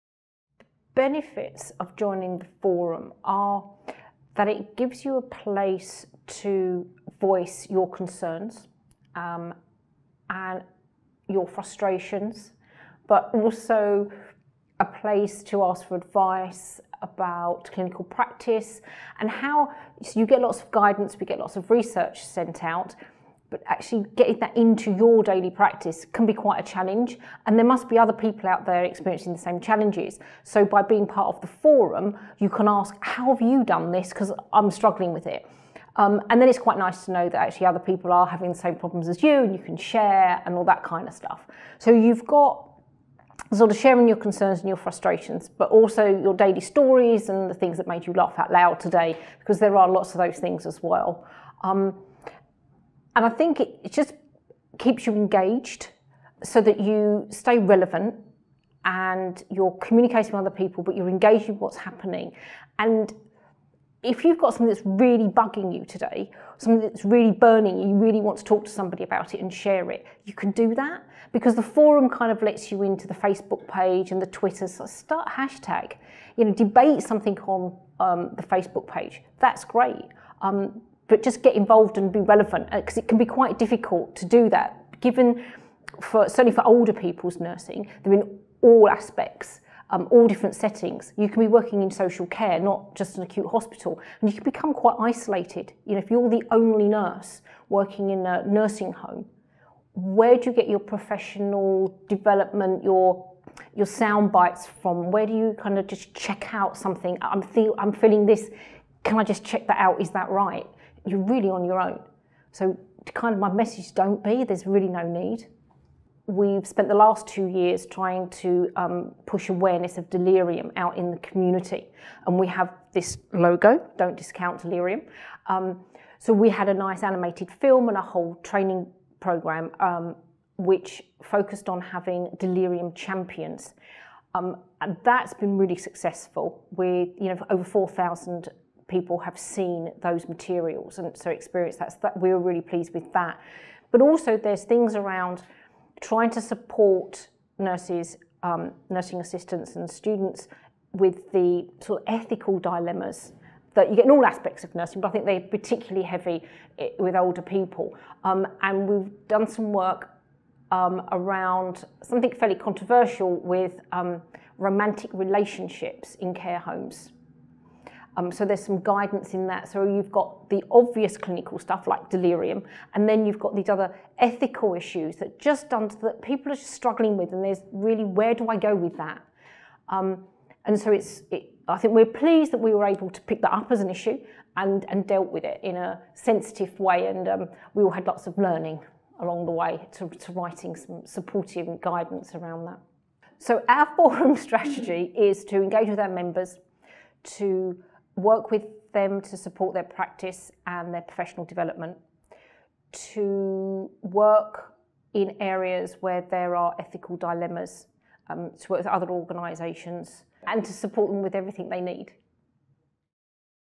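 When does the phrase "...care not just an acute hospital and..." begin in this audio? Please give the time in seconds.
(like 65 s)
92 s.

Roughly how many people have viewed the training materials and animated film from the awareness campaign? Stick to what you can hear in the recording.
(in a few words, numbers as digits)
over 4,000.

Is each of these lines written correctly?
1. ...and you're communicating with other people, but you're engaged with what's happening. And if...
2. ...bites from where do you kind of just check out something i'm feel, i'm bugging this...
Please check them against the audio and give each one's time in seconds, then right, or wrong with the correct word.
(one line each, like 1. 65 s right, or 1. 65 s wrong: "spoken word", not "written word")
1. 58 s right
2. 104 s wrong: "feeling", not "bugging".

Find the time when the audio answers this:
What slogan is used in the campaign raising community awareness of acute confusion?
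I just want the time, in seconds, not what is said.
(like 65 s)
123 s.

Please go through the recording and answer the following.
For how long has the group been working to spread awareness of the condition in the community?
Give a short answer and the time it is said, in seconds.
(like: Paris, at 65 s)
2 years, at 117 s.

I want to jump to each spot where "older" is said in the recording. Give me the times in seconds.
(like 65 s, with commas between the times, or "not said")
86 s, 157 s.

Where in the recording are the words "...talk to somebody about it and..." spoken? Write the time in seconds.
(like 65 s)
68 s.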